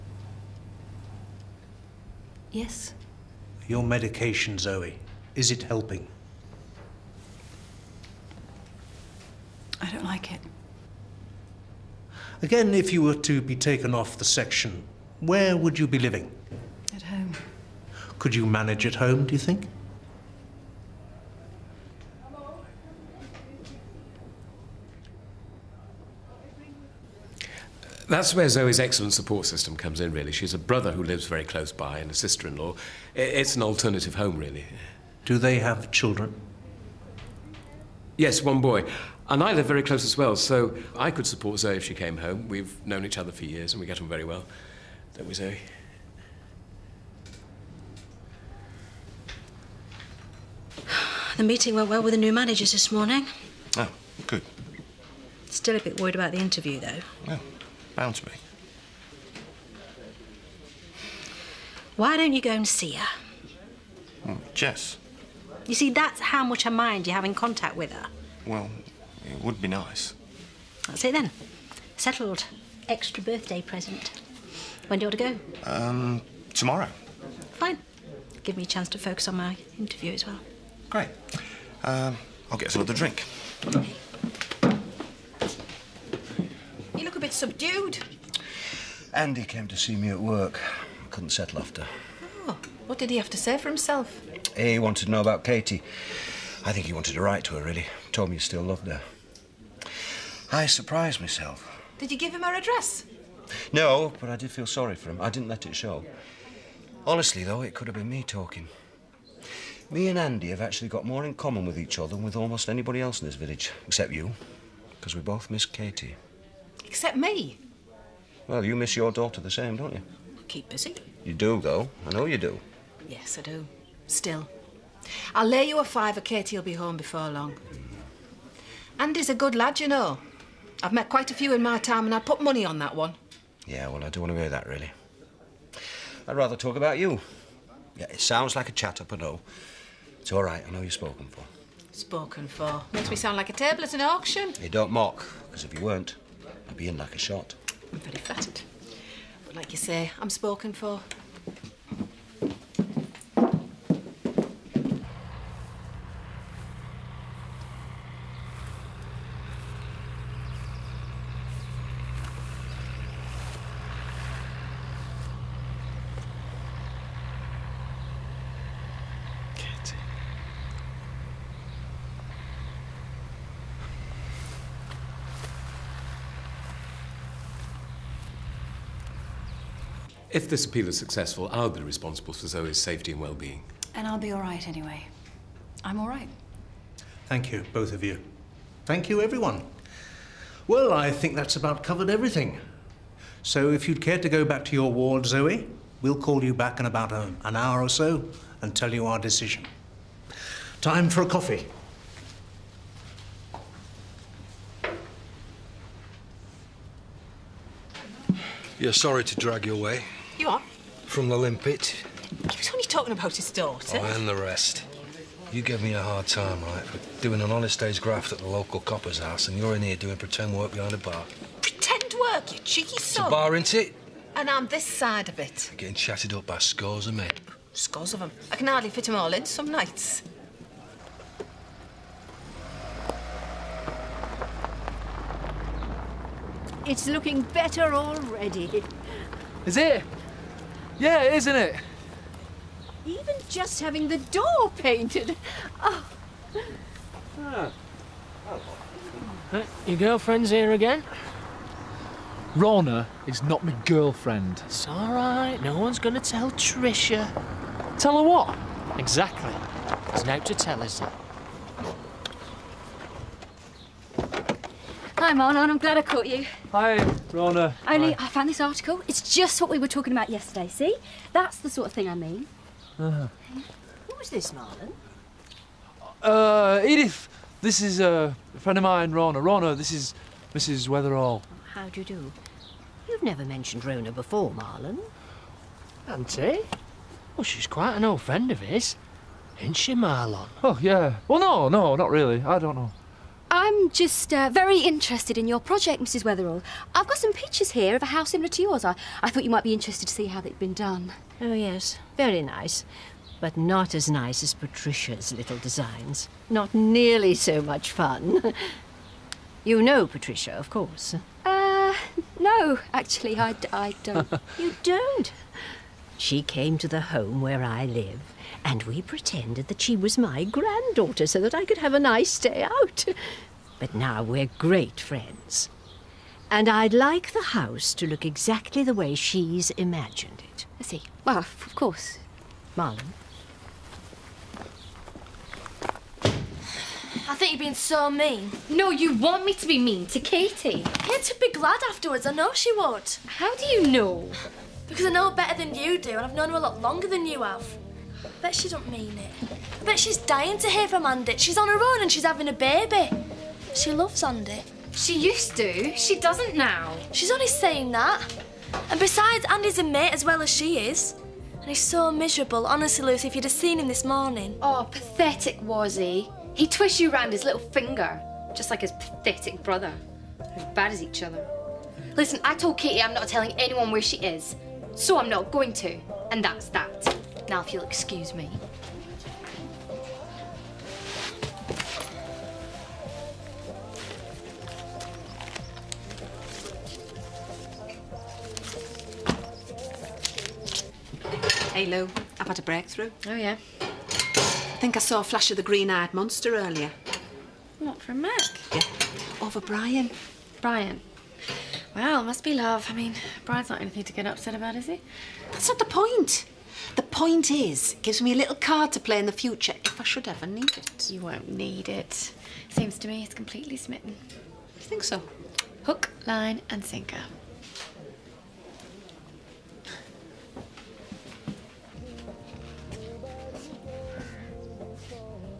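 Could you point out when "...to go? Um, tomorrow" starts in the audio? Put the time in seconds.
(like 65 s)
75 s.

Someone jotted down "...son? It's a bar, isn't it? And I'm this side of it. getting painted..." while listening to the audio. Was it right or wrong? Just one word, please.
wrong.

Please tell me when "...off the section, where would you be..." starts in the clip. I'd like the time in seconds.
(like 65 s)
13 s.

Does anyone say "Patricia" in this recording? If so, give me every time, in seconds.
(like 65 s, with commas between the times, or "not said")
304 s, 310 s.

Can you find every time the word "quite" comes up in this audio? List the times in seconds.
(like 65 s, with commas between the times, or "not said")
131 s, 287 s.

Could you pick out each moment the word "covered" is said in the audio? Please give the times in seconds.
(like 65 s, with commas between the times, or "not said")
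191 s.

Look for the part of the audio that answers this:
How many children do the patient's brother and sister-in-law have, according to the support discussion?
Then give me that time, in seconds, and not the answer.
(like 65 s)
38 s.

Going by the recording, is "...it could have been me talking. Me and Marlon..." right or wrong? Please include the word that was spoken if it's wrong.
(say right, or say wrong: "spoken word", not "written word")
wrong: "Andy", not "Marlon".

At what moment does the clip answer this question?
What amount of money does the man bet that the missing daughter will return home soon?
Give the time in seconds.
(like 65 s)
125 s.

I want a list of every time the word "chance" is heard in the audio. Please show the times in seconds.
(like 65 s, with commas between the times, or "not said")
78 s.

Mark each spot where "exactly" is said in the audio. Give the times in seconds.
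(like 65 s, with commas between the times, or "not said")
258 s, 328 s.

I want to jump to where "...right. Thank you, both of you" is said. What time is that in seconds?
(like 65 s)
186 s.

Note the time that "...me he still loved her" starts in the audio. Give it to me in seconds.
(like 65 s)
98 s.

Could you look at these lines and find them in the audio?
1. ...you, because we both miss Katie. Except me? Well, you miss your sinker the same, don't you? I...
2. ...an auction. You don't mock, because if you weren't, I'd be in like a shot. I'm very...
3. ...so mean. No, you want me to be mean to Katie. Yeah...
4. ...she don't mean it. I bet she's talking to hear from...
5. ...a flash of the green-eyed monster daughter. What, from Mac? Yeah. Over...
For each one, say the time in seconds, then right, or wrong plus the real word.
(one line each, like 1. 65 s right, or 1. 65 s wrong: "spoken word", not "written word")
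1. 114 s wrong: "daughter", not "sinker"
2. 143 s right
3. 337 s right
4. 348 s wrong: "dying", not "talking"
5. 395 s wrong: "earlier", not "daughter".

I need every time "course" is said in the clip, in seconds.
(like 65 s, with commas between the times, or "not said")
310 s, 331 s.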